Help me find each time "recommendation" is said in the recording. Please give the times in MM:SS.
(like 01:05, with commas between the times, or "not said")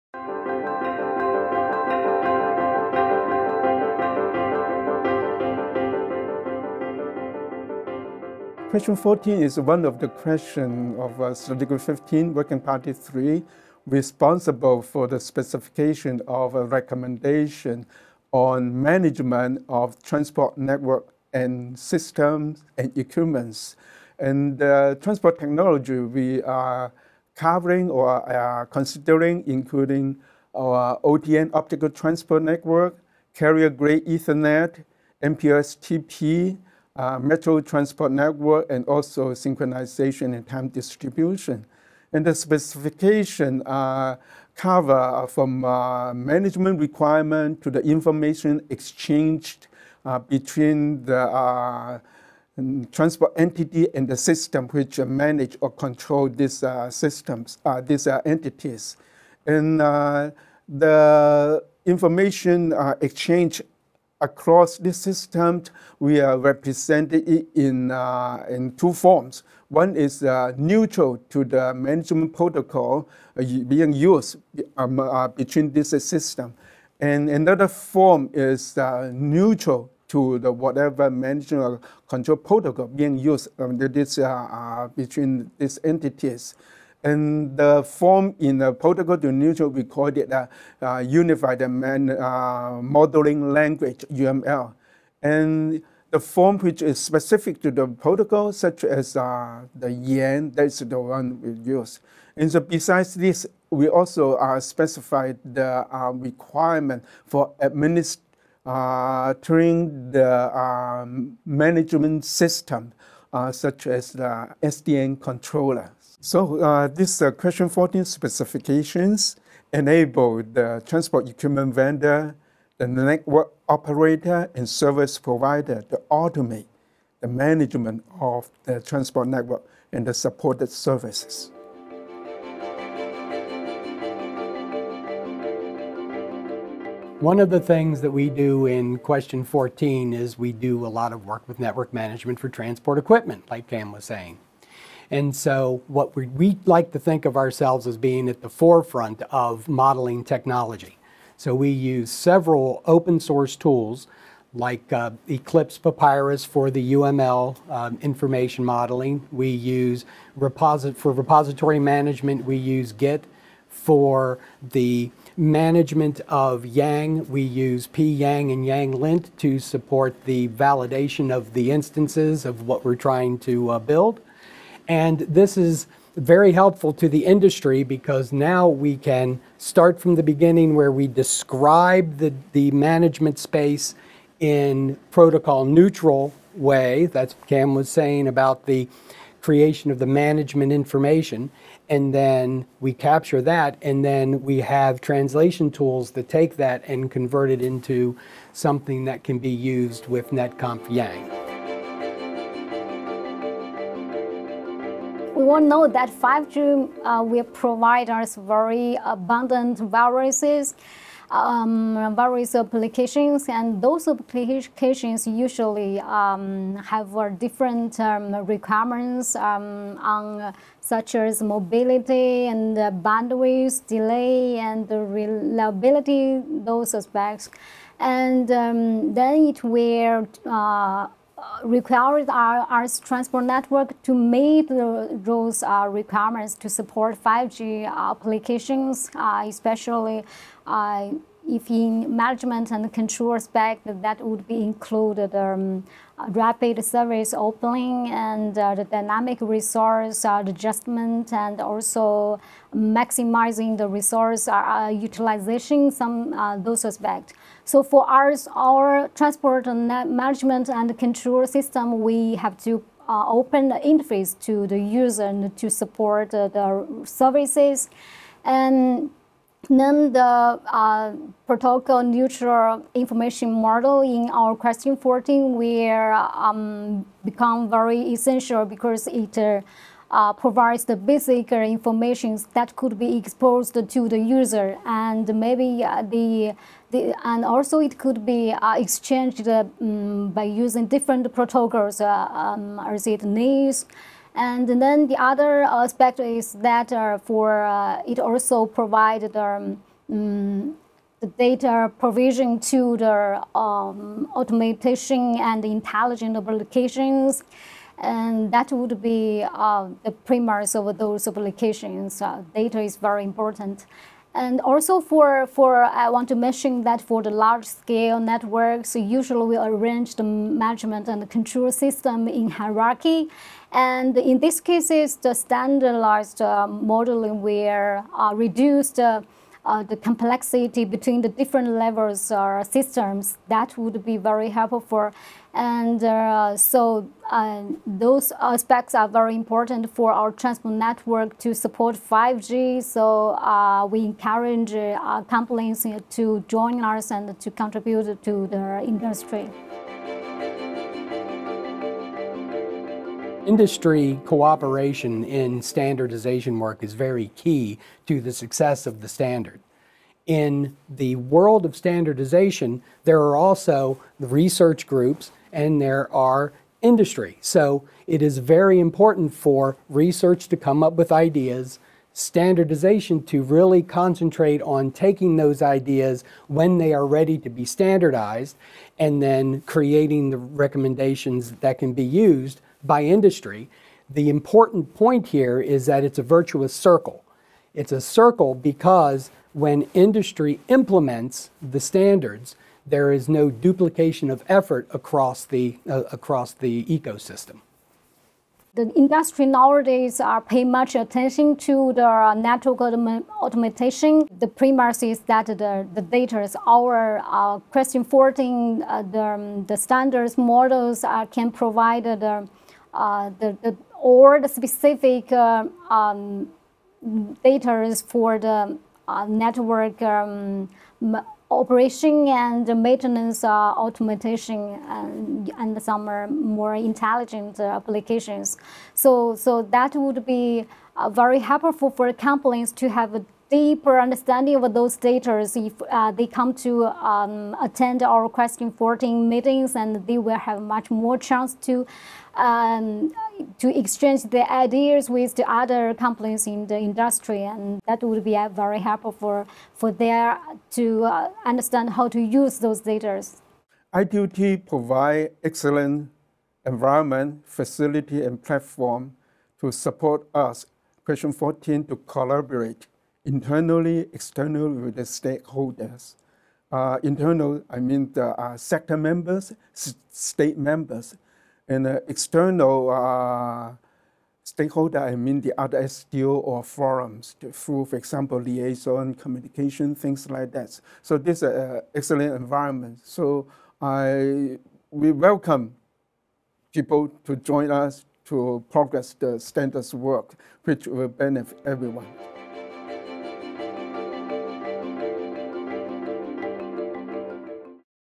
00:16, 06:20.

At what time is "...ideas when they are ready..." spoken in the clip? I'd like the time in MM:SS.
06:15.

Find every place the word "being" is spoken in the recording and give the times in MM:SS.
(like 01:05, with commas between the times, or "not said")
01:13, 01:22, 02:27.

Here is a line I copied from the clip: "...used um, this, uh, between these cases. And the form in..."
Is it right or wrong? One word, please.
wrong.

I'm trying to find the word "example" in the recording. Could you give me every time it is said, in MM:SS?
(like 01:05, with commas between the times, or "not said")
07:57.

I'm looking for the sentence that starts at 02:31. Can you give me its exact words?
So we use several open source tools like uh, Eclipse Papyrus for the UML um, information modeling.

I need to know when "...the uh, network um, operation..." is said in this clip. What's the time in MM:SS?
06:58.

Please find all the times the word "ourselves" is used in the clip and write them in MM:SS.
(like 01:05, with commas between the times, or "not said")
02:27.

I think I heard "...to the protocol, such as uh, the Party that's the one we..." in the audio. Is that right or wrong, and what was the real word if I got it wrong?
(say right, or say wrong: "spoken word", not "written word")
wrong: "YANG", not "Party".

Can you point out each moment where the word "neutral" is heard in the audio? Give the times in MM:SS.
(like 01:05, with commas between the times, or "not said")
01:10, 01:19, 01:29, 03:05, 04:32.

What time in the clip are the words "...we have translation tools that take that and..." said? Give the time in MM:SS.
03:14.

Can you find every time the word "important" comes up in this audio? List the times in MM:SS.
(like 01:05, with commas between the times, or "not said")
05:13, 05:39, 06:08, 06:24.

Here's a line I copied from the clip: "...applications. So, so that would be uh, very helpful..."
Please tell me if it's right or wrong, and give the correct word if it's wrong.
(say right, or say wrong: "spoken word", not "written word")
right.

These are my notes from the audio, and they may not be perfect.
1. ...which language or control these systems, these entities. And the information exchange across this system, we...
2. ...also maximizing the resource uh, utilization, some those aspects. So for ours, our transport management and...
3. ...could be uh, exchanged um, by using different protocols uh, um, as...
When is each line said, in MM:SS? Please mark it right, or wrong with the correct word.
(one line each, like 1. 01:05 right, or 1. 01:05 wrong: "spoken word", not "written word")
1. 00:54 wrong: "manage", not "language"
2. 04:11 right
3. 04:47 right.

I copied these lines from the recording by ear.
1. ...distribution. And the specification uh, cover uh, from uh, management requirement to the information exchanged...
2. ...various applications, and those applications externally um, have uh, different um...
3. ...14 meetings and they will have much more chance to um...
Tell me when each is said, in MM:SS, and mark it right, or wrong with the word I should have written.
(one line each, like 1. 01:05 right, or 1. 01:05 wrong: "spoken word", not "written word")
1. 00:40 right
2. 03:32 wrong: "usually", not "externally"
3. 07:18 right.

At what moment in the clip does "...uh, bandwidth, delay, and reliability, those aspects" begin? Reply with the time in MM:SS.
03:42.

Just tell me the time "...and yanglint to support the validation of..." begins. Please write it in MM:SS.
02:48.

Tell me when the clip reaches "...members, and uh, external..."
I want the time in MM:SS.
07:50.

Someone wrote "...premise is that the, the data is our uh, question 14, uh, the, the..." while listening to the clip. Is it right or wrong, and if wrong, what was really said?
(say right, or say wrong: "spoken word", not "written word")
right.